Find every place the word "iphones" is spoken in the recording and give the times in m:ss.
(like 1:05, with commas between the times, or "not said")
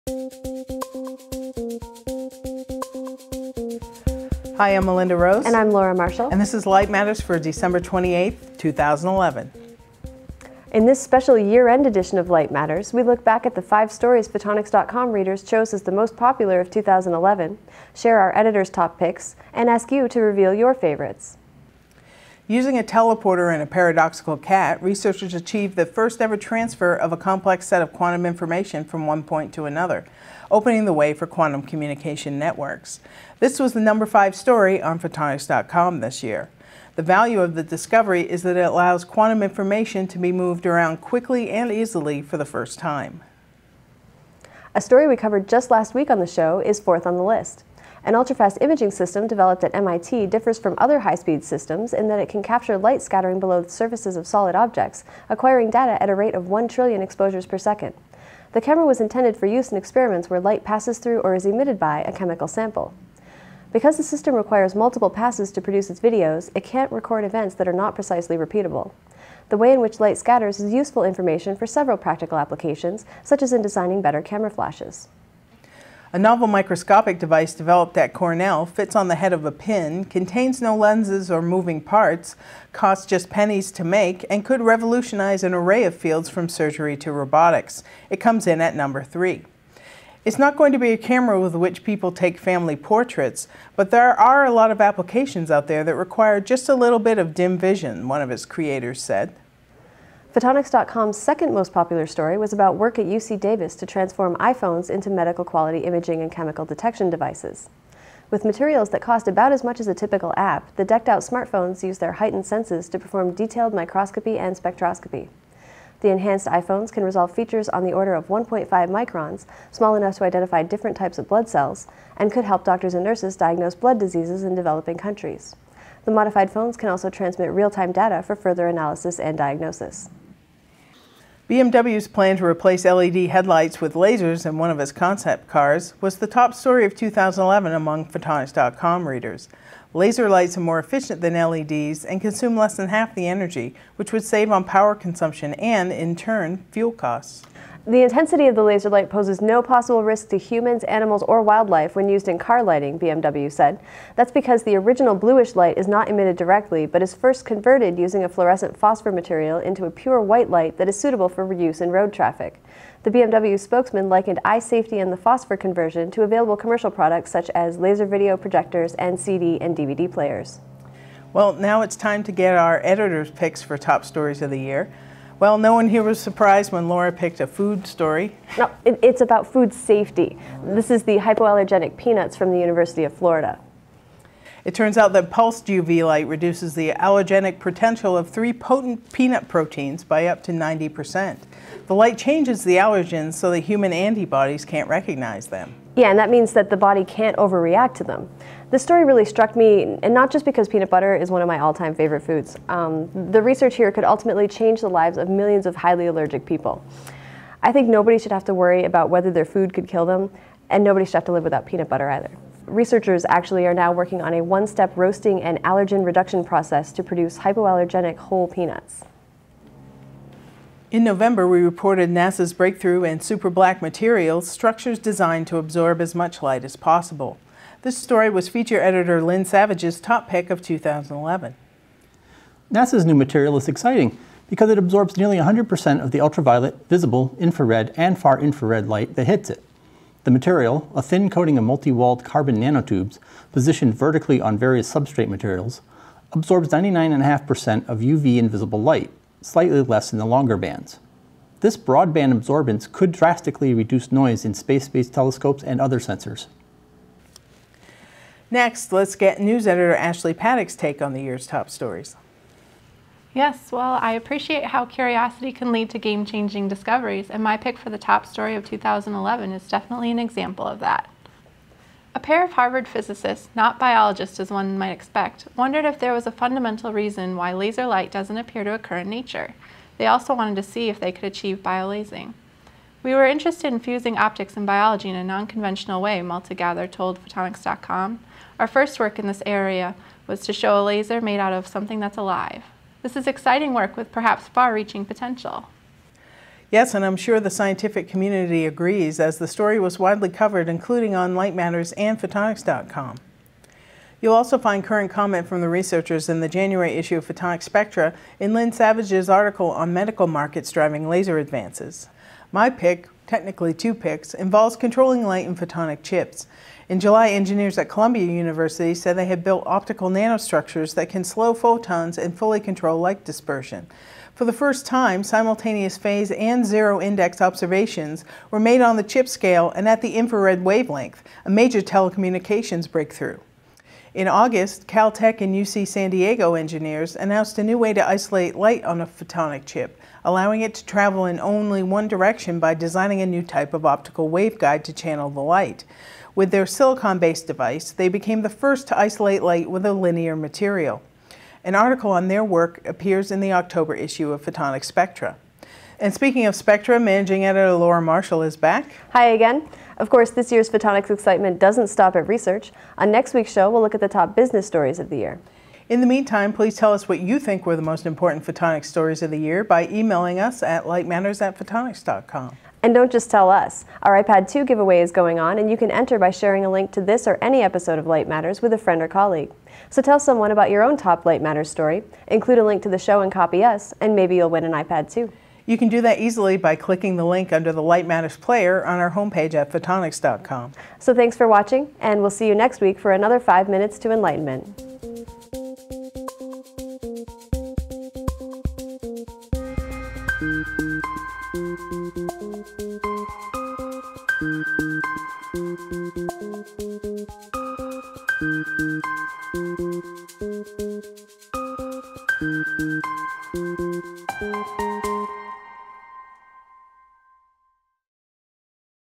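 1:44, 1:56.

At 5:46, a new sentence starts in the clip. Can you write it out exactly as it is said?
With their silicon-based device, they became the first to isolate light with a linear material.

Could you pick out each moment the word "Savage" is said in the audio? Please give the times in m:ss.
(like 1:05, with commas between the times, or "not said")
3:49, 5:08.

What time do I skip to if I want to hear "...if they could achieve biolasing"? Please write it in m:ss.
4:40.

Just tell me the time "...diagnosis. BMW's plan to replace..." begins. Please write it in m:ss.
2:09.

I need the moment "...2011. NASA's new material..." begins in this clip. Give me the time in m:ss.
3:50.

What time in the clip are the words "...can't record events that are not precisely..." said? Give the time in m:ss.
1:06.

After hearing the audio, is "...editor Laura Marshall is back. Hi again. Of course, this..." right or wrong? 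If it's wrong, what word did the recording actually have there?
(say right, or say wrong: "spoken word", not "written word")
right.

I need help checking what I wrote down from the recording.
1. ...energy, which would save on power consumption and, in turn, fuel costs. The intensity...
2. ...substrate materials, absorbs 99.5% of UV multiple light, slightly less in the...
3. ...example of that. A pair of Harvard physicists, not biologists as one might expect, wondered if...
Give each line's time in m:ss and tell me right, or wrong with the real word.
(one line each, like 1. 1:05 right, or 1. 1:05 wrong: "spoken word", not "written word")
1. 2:23 right
2. 4:04 wrong: "invisible", not "multiple"
3. 4:30 right.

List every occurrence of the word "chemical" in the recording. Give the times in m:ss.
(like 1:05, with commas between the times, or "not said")
1:02, 1:46.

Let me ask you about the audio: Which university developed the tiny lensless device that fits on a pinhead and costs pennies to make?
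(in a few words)
Cornell.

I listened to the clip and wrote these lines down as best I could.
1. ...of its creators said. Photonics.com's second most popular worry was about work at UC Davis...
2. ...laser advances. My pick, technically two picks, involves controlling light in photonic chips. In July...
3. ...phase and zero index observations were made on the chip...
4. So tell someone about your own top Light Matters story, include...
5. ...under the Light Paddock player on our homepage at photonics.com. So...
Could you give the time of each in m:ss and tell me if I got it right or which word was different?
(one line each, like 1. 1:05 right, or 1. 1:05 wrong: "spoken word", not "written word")
1. 1:38 wrong: "story", not "worry"
2. 5:11 right
3. 5:25 right
4. 6:19 right
5. 6:27 wrong: "Matters", not "Paddock".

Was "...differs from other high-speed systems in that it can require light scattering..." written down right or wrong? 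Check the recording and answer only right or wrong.
wrong.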